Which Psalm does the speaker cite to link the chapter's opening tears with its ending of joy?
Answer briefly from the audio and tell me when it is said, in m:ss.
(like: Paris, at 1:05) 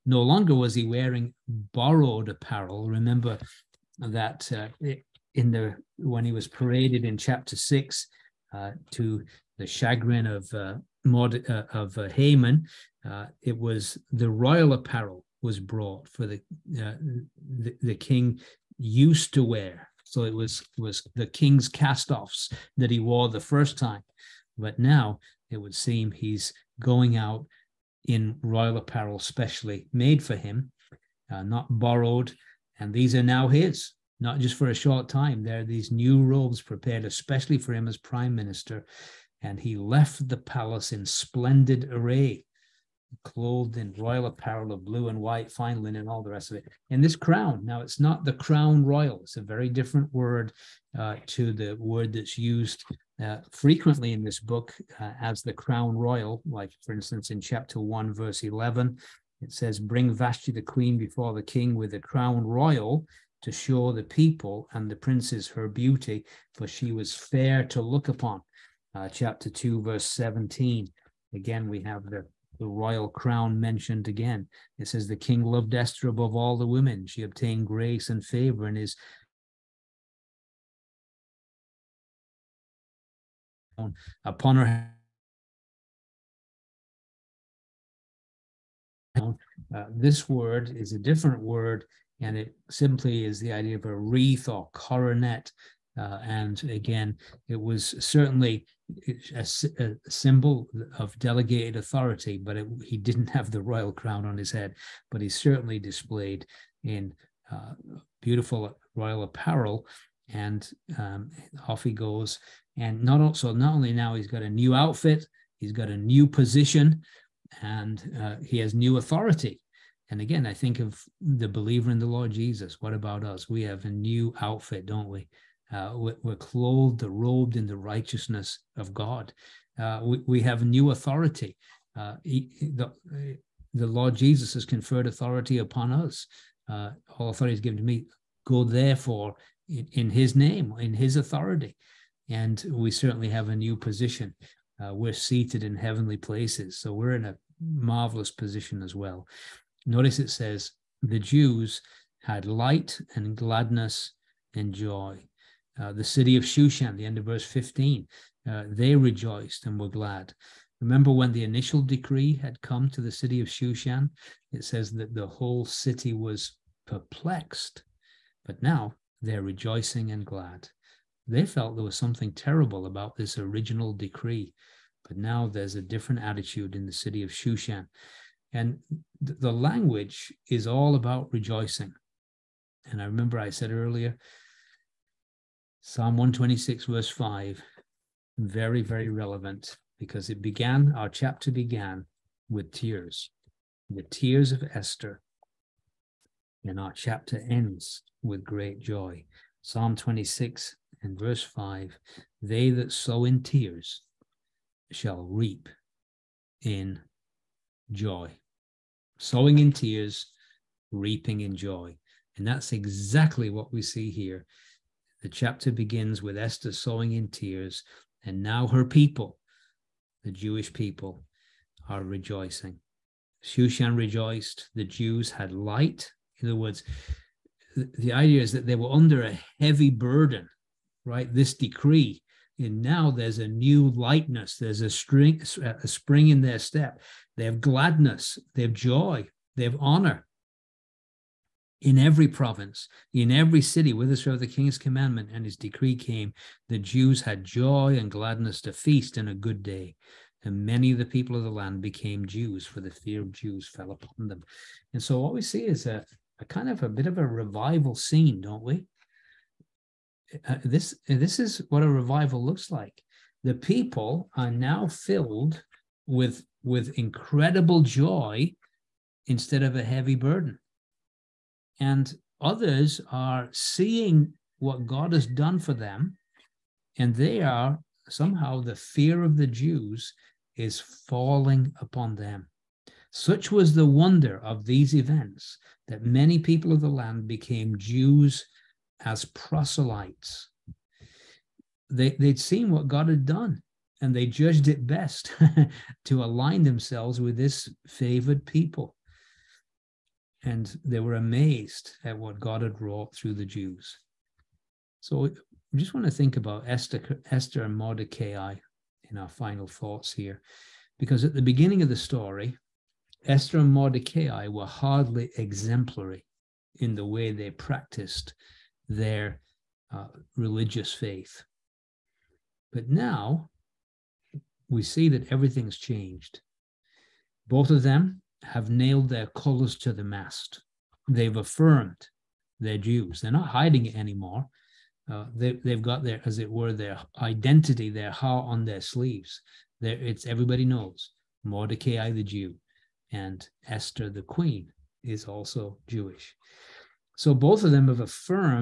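Psalm 126, at 3:05.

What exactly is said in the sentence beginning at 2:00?
And again, I think of the believer in the Lord Jesus.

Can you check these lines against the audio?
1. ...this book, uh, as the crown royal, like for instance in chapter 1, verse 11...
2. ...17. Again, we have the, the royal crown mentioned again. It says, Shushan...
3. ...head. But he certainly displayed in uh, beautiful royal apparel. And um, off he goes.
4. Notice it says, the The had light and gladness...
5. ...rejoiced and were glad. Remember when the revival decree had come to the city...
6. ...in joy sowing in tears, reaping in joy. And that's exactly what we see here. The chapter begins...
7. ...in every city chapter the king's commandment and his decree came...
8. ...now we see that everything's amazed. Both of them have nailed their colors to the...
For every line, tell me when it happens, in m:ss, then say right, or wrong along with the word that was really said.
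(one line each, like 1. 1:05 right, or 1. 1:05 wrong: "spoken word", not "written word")
1. 0:54 right
2. 1:10 wrong: "The", not "Shushan"
3. 1:44 right
4. 2:29 wrong: "Jews", not "The"
5. 2:38 wrong: "initial", not "revival"
6. 3:26 right
7. 4:03 wrong: "whithersoever", not "chapter"
8. 5:22 wrong: "changed", not "amazed".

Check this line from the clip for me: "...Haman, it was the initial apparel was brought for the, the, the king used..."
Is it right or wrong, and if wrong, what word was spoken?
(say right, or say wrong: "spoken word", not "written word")
wrong: "royal", not "initial".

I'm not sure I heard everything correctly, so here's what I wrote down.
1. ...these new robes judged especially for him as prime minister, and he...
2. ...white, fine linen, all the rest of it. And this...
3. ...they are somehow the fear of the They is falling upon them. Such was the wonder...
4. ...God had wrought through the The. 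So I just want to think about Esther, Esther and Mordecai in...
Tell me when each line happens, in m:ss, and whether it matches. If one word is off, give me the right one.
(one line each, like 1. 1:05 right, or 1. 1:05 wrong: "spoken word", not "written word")
1. 0:35 wrong: "prepared", not "judged"
2. 0:45 right
3. 4:37 wrong: "Jews", not "They"
4. 5:02 wrong: "Jews", not "The".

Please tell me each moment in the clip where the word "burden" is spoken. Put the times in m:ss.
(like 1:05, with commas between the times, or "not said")
3:49, 4:30.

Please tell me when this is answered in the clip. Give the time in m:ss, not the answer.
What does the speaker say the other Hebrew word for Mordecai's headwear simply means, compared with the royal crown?
1:33.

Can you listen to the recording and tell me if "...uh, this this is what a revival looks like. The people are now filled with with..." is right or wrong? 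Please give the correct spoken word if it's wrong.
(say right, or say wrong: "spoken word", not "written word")
right.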